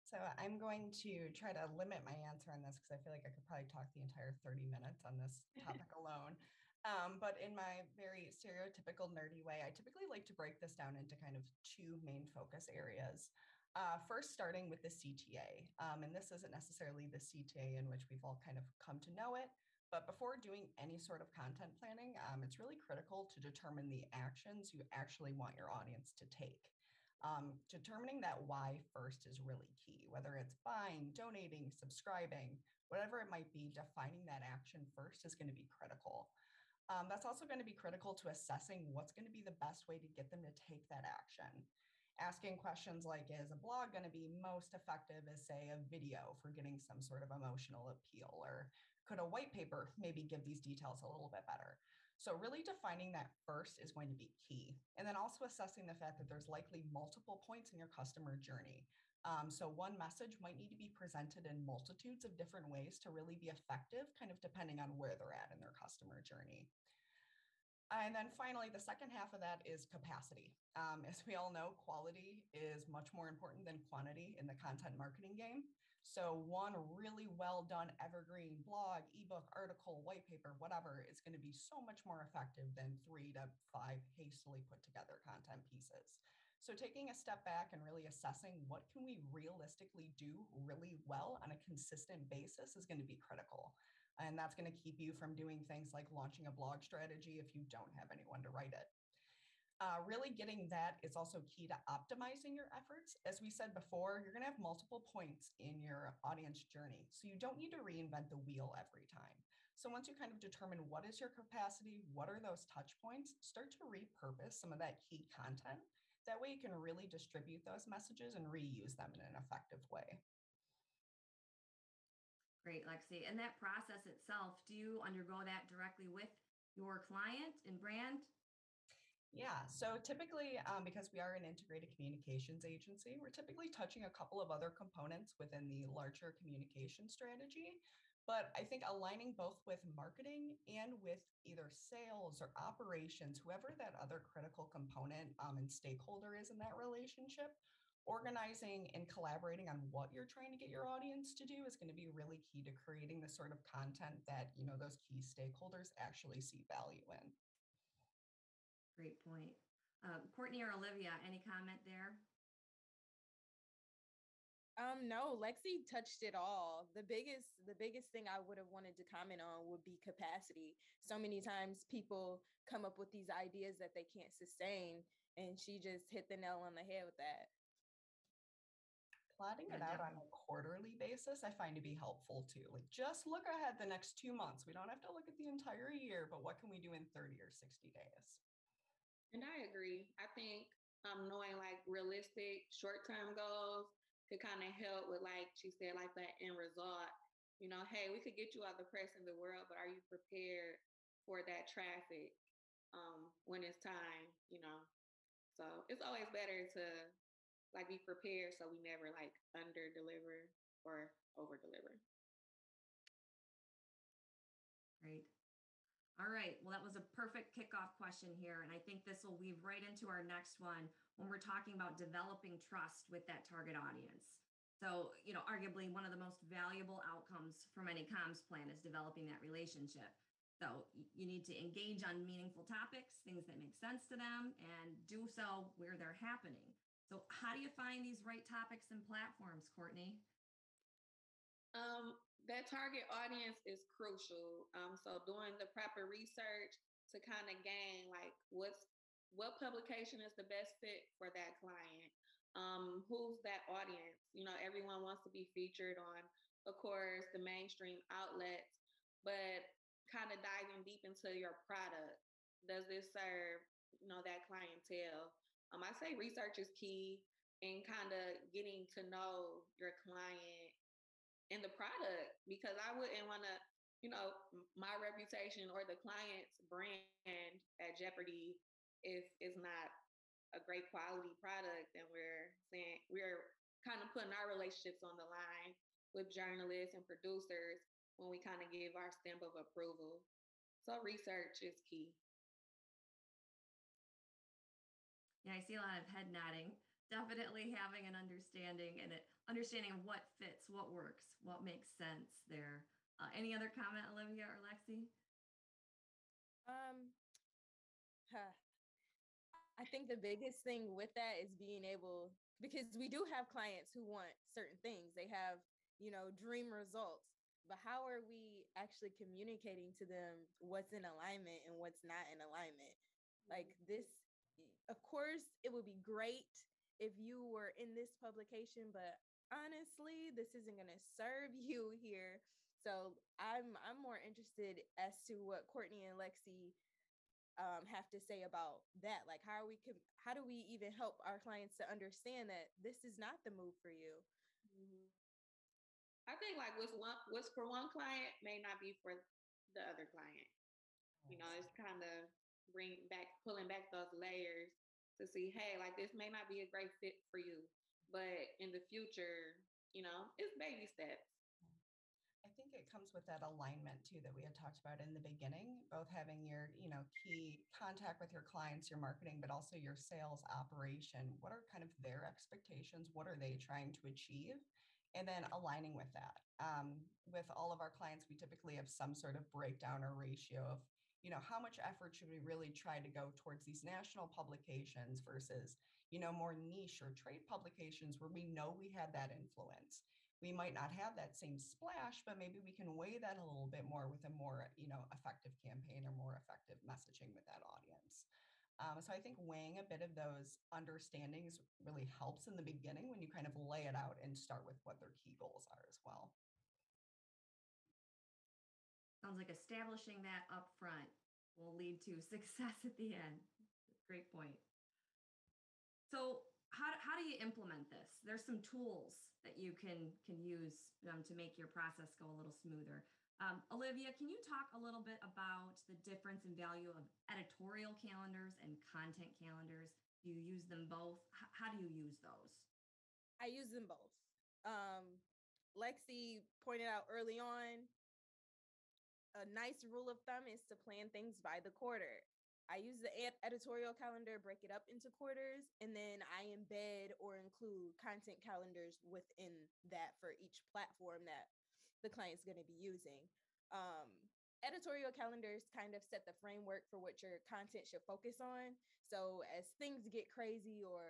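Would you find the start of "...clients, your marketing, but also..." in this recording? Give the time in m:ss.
6:08.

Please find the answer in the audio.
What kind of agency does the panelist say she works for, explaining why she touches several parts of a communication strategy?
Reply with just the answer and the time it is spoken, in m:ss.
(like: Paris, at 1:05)
integrated communications agency, at 2:11.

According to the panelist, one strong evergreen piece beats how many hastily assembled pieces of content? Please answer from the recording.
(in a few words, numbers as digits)
3 to 5.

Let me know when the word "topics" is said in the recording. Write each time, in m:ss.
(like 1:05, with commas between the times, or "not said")
0:05, 3:52, 3:58.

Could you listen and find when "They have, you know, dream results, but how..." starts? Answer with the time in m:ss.
5:15.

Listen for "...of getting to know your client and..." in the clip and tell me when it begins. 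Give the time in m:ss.
4:28.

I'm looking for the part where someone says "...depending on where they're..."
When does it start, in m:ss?
1:04.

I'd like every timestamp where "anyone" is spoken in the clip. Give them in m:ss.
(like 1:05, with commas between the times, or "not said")
1:38.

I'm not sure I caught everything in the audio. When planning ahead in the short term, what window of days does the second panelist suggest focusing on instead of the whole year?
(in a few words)
30 or 60 days.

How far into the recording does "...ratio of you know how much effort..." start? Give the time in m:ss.
6:20.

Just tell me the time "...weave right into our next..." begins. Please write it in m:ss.
3:39.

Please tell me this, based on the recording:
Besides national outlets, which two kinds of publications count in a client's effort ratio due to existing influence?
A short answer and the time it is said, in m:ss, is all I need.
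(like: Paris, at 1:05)
niche or trade, at 6:26.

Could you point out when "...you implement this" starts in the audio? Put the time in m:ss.
6:57.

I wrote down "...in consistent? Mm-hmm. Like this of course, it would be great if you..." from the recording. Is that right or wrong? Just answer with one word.
wrong.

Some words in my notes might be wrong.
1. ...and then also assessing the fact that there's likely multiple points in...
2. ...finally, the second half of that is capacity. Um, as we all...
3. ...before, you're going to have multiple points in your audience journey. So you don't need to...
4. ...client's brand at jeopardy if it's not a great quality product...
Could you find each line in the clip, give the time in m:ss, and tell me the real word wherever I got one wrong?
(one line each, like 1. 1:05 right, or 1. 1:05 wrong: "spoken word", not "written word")
1. 0:54 right
2. 1:08 right
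3. 1:43 right
4. 4:35 right.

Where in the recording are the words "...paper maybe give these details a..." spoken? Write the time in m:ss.
0:49.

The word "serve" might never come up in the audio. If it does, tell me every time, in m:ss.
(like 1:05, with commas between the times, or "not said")
4:23, 5:30.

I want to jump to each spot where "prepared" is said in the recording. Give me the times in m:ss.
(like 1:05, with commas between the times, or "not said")
3:20, 3:27.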